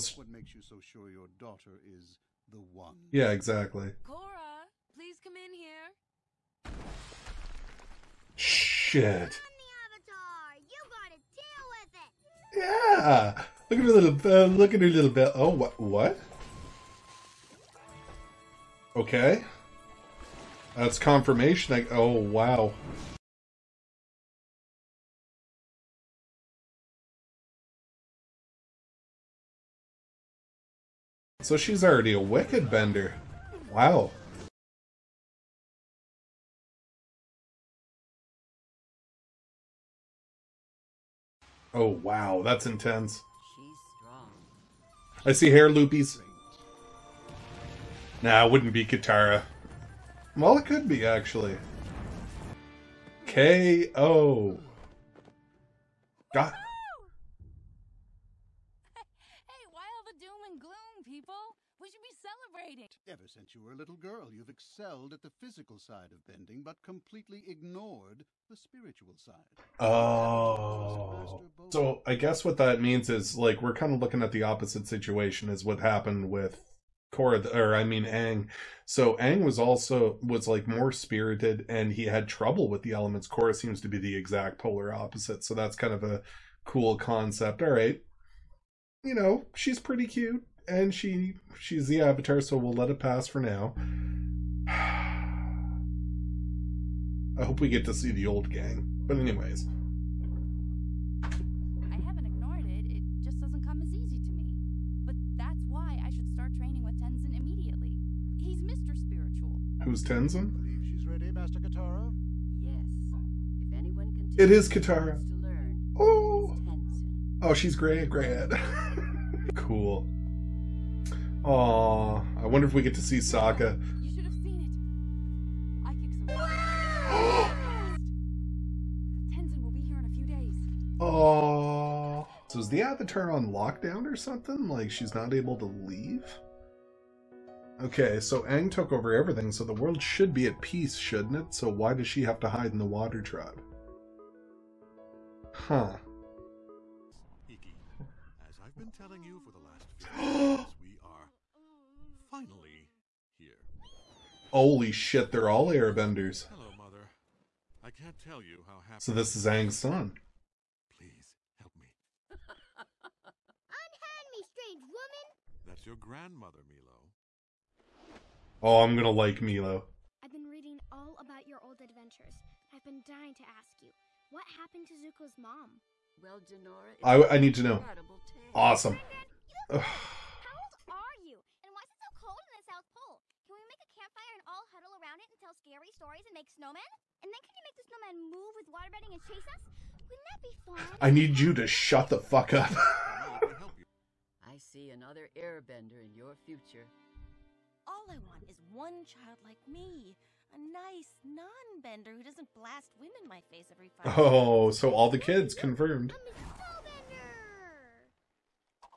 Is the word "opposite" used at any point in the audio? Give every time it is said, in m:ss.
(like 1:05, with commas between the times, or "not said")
1:14, 1:24.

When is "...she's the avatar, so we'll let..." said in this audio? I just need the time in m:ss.
1:31.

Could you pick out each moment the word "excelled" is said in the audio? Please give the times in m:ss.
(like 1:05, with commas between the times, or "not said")
1:04.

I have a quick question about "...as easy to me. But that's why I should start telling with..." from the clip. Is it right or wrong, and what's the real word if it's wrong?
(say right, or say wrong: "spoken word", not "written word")
wrong: "training", not "telling".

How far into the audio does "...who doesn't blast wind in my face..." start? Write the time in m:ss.
3:22.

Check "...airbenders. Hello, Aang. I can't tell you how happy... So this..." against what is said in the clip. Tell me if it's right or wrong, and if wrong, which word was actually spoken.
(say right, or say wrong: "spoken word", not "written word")
wrong: "Mother", not "Aang".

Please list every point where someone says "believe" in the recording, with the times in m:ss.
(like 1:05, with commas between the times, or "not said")
1:50.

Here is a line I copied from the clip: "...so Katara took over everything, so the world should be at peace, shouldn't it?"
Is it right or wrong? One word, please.
wrong.